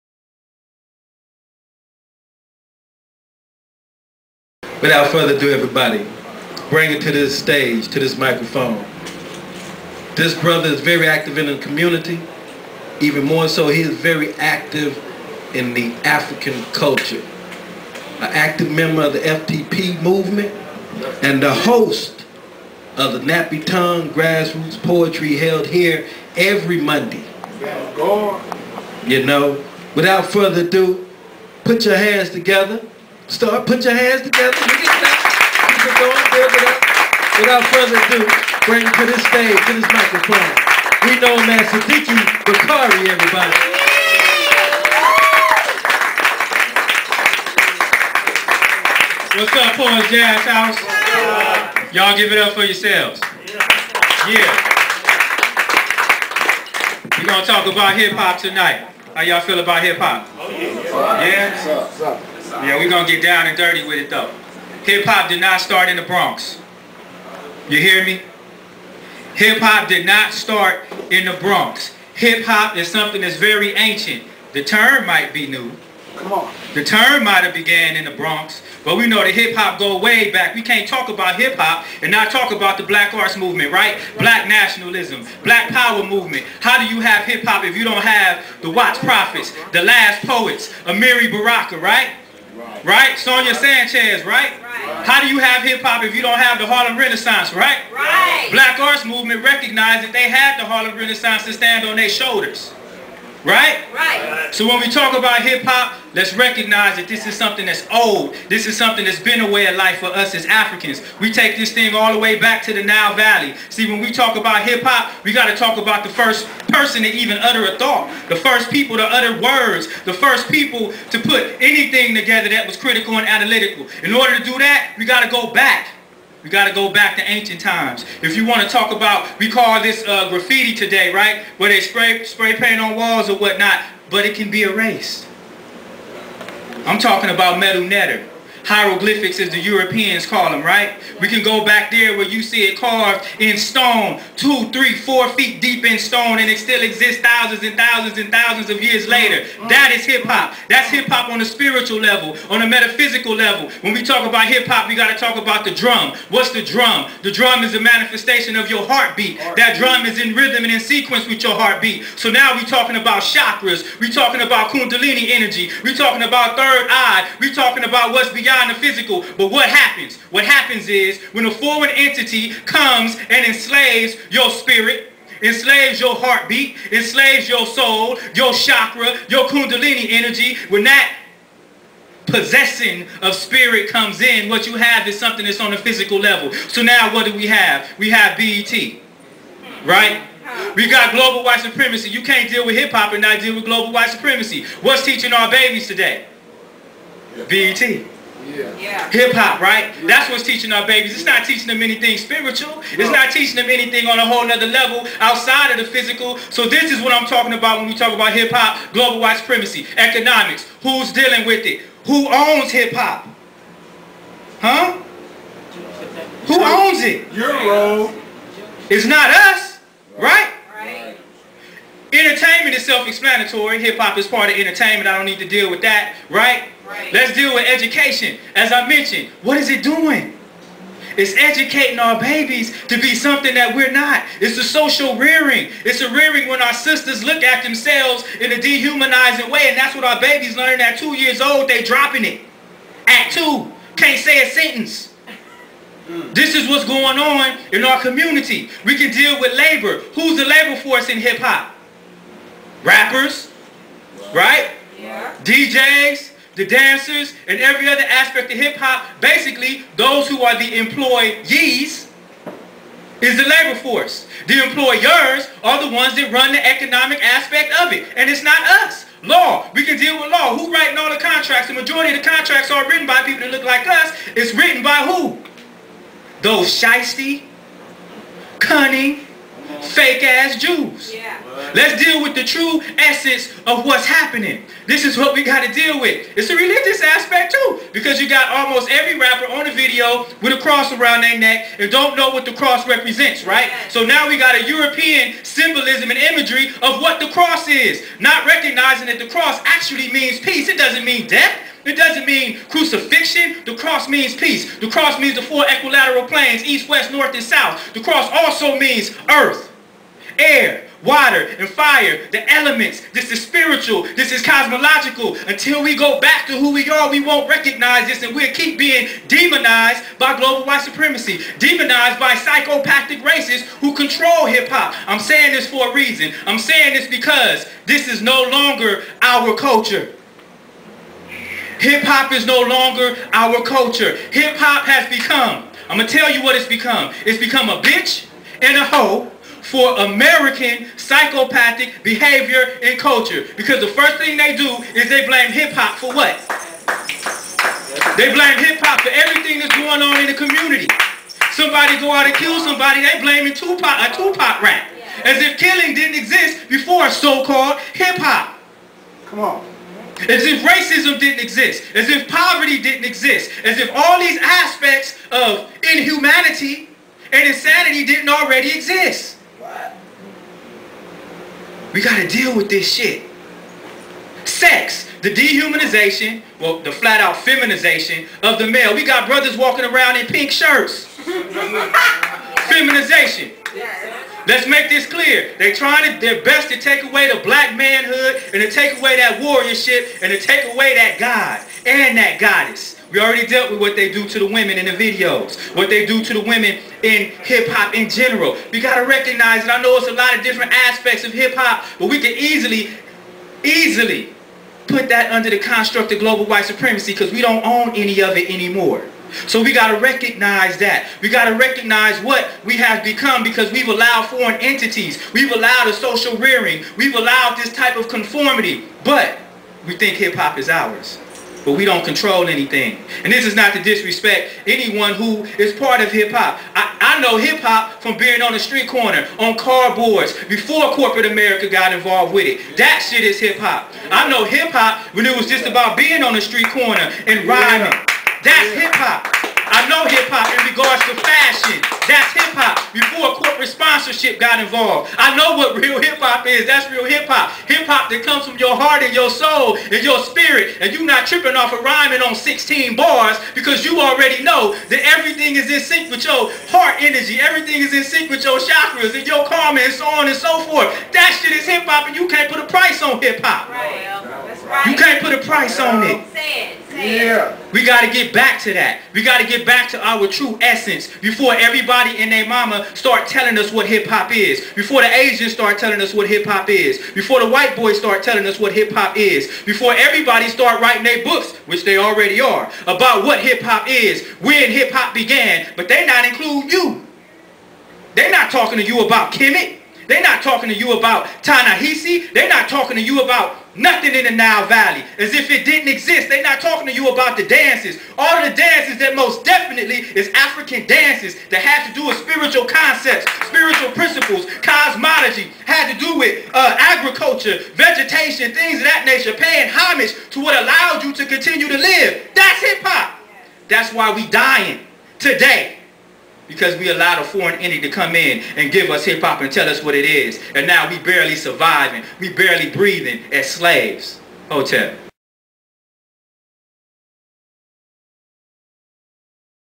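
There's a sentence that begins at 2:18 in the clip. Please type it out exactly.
Hieroglyphics as the Europeans call them, right?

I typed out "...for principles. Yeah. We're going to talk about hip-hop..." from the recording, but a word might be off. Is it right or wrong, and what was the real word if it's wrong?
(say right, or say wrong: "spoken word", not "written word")
wrong: "yourselves", not "principles".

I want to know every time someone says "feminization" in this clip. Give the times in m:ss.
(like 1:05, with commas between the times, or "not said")
6:17, 6:22.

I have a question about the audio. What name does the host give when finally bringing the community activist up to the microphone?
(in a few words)
Sadiki Bakari.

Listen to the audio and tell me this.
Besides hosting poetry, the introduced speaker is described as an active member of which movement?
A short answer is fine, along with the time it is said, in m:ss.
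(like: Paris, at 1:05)
FTP movement, at 0:19.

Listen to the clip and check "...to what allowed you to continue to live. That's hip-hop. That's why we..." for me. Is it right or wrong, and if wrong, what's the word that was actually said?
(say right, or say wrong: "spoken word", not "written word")
right.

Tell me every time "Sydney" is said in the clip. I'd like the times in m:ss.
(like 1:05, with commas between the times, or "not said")
not said.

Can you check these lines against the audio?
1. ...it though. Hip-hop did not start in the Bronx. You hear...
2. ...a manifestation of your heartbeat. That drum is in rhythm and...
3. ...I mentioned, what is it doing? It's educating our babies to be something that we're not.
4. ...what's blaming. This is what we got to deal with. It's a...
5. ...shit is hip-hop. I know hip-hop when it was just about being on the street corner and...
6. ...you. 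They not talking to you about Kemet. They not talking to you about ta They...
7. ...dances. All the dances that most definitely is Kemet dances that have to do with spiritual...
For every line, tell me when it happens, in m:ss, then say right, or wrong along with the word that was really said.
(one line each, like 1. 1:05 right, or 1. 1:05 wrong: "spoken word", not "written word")
1. 1:03 right
2. 2:37 right
3. 3:48 right
4. 4:43 wrong: "happening", not "blaming"
5. 7:13 right
6. 8:06 right
7. 8:17 wrong: "African", not "Kemet".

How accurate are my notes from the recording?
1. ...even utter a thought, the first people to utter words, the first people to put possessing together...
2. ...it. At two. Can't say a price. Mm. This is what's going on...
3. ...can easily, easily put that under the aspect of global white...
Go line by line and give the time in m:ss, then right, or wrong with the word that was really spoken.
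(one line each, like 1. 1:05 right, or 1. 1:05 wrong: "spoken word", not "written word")
1. 1:57 wrong: "anything", not "possessing"
2. 4:02 wrong: "sentence", not "price"
3. 6:42 wrong: "construct", not "aspect".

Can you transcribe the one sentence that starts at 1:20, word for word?
We can't talk about hip-hop and not talk about the black arts movement, right?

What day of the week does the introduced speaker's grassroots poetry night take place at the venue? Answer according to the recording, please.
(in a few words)
Monday.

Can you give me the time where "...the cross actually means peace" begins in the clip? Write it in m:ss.
4:59.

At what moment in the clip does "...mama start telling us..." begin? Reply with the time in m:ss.
7:52.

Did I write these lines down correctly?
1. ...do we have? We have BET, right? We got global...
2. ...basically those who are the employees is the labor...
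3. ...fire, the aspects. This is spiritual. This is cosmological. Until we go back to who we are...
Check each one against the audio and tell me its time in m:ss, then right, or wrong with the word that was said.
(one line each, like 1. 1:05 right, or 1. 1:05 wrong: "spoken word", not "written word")
1. 3:07 right
2. 4:19 right
3. 5:11 wrong: "elements", not "aspects".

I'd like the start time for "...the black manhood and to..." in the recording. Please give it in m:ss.
6:27.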